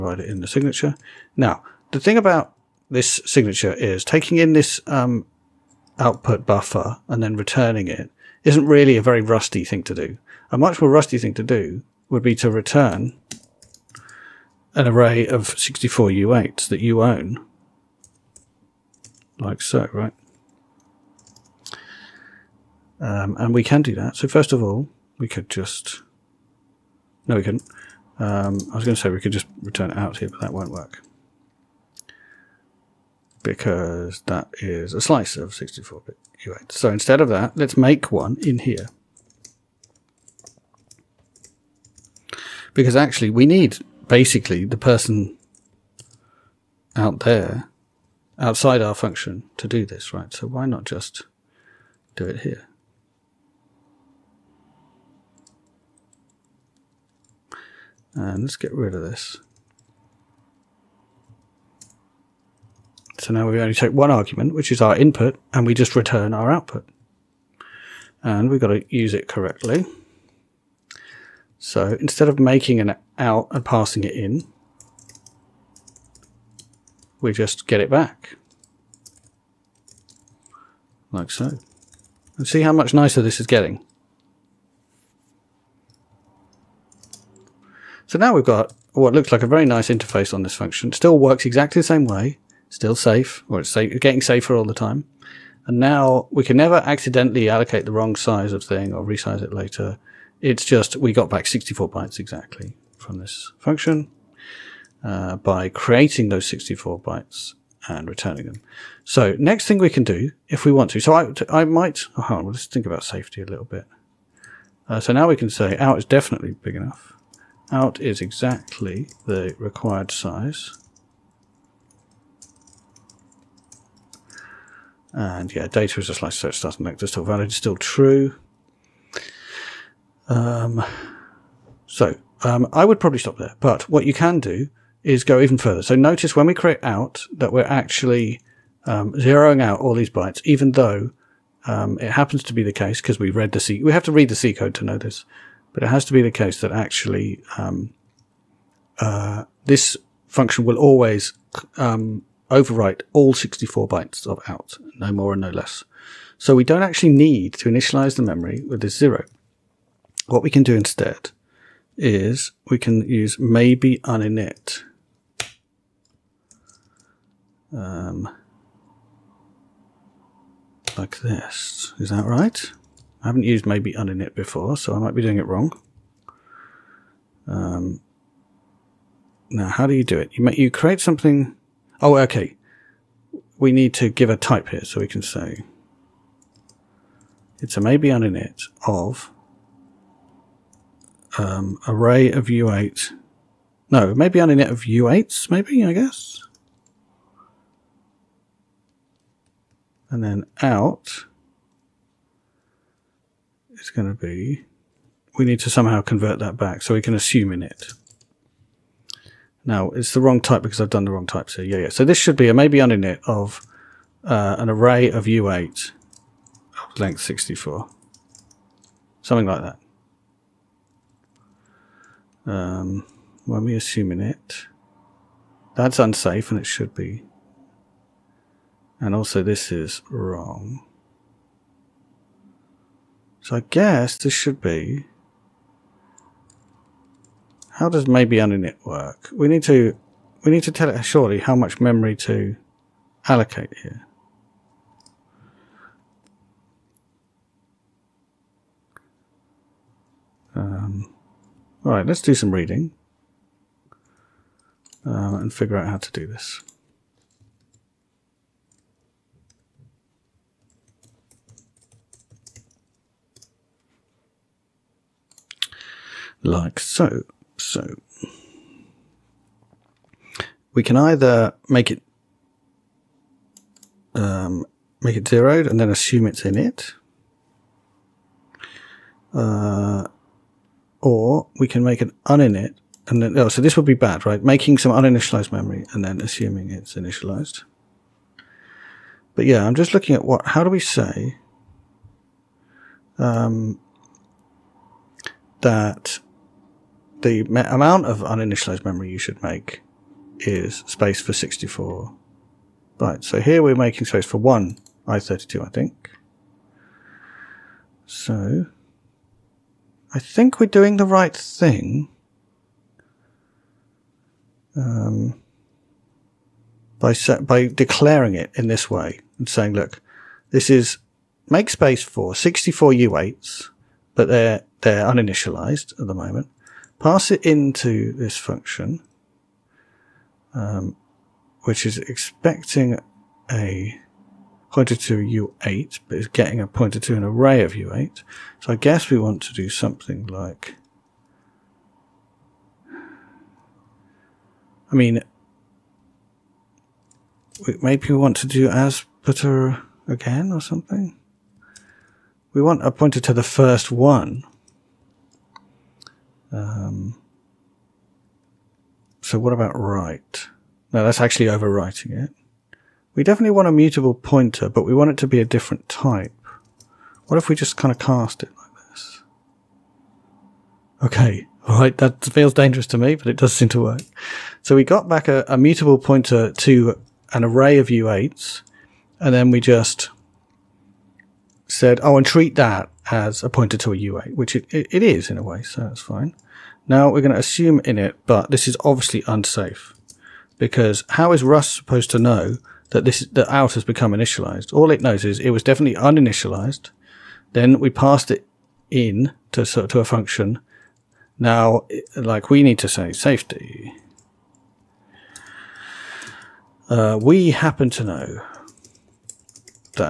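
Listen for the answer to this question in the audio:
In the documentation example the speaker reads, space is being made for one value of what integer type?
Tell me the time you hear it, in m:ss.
5:05.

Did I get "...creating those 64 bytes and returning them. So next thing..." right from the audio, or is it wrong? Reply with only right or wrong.
right.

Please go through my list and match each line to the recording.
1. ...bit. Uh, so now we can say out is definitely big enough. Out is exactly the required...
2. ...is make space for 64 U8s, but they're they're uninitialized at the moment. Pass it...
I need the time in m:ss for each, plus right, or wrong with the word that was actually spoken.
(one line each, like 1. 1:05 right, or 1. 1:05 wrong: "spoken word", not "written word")
1. 1:53 right
2. 5:20 right.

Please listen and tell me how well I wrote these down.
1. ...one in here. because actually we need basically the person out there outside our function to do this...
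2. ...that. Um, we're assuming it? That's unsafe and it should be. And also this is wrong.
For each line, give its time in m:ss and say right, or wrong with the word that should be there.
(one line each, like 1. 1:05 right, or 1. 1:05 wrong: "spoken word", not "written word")
1. 0:38 right
2. 3:39 right.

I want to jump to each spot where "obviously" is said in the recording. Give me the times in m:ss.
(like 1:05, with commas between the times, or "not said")
6:28.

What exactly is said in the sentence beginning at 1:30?
still works exactly the same way.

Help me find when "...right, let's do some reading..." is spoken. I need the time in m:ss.
4:11.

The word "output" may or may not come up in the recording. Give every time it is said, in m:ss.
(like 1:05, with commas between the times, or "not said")
0:05, 1:06.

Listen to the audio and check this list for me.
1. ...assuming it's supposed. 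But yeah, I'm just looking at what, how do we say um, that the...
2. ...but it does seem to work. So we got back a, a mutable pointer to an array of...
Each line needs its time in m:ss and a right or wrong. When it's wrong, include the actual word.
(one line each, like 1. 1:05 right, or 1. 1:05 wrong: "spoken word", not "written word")
1. 4:46 wrong: "initialized", not "supposed"
2. 6:13 right.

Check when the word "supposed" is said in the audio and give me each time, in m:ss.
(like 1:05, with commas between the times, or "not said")
6:31.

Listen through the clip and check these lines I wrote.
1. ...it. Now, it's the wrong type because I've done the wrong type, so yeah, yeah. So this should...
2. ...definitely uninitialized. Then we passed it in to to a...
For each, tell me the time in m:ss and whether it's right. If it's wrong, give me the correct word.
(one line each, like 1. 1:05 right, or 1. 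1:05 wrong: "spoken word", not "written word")
1. 3:27 right
2. 6:35 right.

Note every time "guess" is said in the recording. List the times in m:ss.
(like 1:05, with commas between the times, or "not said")
3:15, 3:53, 5:38.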